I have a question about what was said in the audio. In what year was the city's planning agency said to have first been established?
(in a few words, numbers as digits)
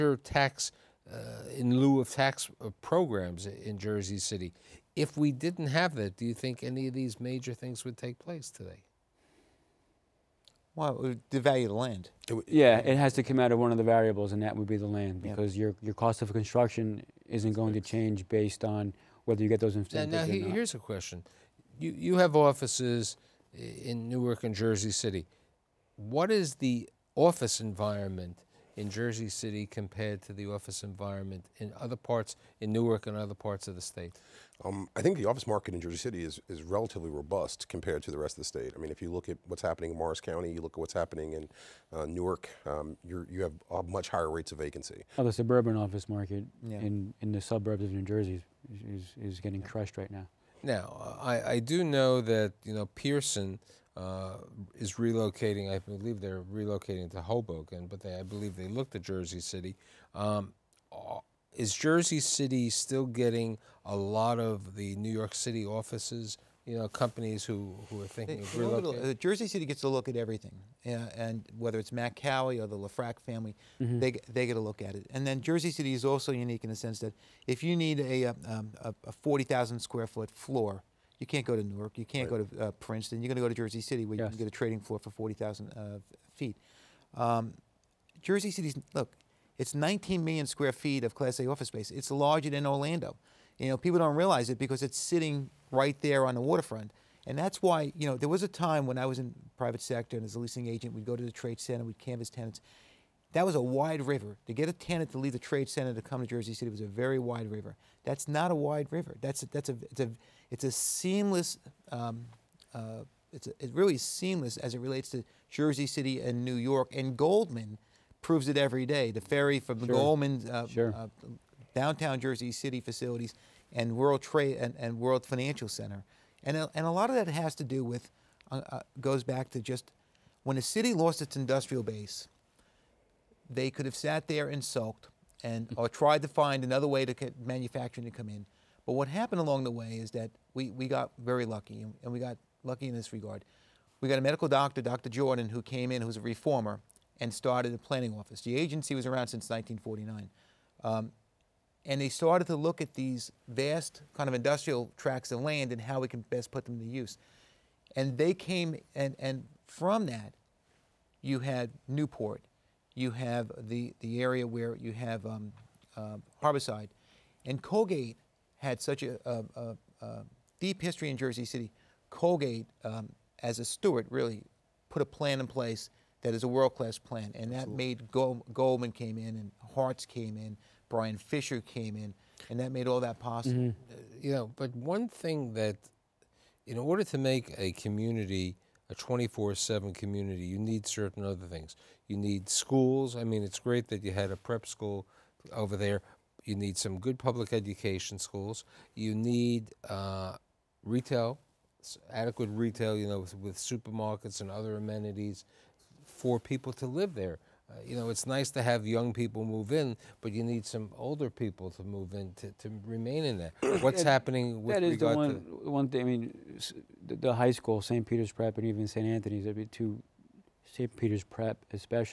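1949.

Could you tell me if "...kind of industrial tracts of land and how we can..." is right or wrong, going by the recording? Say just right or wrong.
right.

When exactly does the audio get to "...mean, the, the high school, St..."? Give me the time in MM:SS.
03:36.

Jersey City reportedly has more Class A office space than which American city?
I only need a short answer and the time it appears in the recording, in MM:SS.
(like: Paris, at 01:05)
Orlando, at 01:32.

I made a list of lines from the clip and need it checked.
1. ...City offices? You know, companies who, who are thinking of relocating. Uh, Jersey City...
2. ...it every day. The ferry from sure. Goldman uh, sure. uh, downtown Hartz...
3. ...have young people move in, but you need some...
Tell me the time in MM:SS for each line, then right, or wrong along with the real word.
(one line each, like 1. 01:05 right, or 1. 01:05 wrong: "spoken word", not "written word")
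1. 01:05 right
2. 01:58 wrong: "Jersey", not "Hartz"
3. 03:28 right.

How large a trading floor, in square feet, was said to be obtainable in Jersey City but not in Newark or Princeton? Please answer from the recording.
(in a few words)
40,000.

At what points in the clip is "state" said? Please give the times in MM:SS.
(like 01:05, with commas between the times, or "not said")
00:33, 00:38.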